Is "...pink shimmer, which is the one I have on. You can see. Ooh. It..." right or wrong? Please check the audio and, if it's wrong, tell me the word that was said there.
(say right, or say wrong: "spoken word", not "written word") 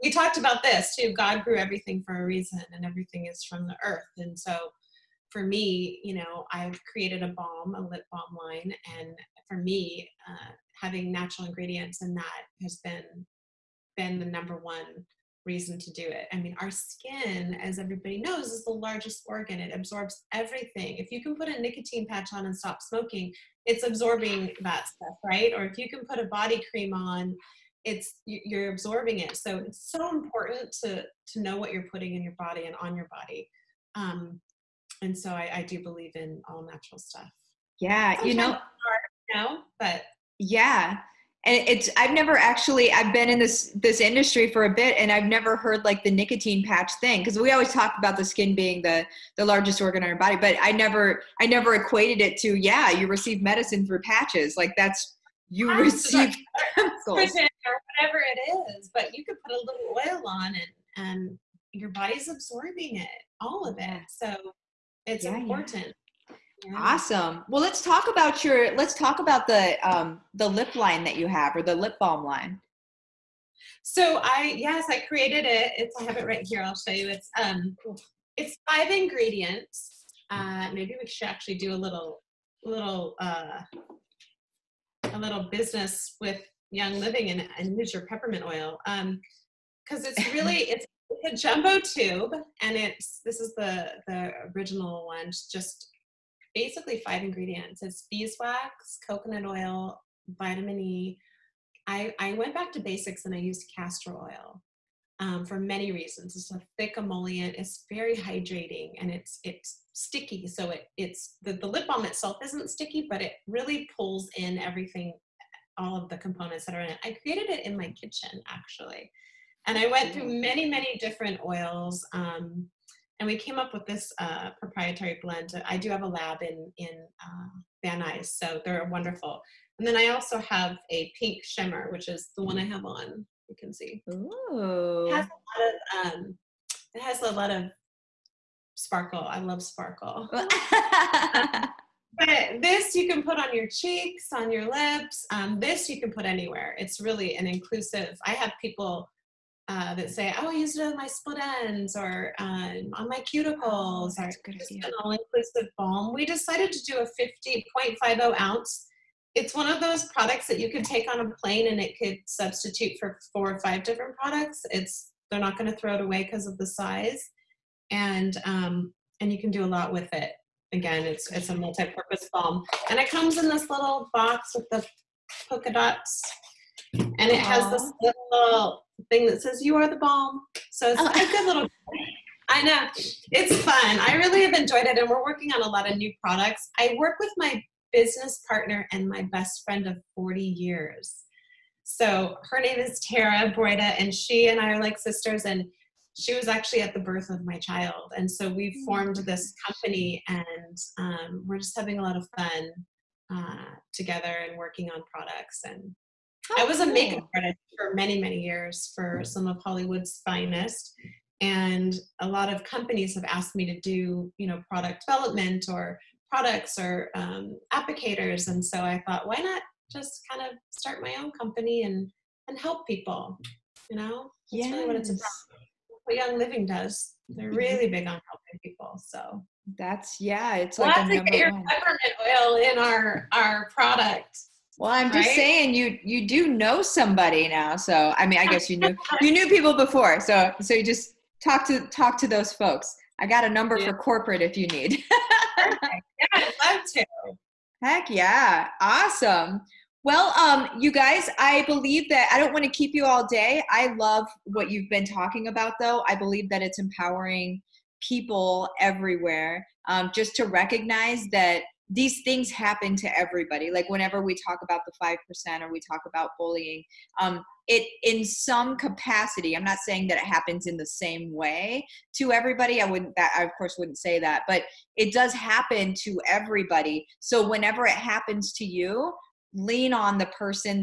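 right.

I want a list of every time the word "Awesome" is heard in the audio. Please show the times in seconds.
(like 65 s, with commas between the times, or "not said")
66 s, 248 s.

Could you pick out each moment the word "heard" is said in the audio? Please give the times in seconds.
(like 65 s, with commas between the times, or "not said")
45 s.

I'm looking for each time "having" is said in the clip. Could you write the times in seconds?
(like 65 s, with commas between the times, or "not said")
10 s, 201 s.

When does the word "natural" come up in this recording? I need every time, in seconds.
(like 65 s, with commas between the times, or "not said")
11 s, 36 s.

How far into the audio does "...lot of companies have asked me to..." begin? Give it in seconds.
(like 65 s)
212 s.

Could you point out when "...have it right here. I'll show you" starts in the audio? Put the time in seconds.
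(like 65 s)
76 s.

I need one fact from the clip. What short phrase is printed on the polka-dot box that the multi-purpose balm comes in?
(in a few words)
You are the balm.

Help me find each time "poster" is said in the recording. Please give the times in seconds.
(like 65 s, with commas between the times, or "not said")
not said.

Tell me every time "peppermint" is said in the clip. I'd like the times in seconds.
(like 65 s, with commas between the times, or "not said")
88 s, 231 s.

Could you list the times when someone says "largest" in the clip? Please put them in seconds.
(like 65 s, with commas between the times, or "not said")
18 s, 49 s.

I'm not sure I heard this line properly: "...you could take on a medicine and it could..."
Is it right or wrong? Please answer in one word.
wrong.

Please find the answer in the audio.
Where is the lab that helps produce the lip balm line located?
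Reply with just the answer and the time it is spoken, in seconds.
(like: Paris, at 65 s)
Van Nuys, at 127 s.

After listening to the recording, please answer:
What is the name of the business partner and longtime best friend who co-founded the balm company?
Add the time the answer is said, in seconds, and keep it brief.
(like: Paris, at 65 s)
Tara Broida, at 193 s.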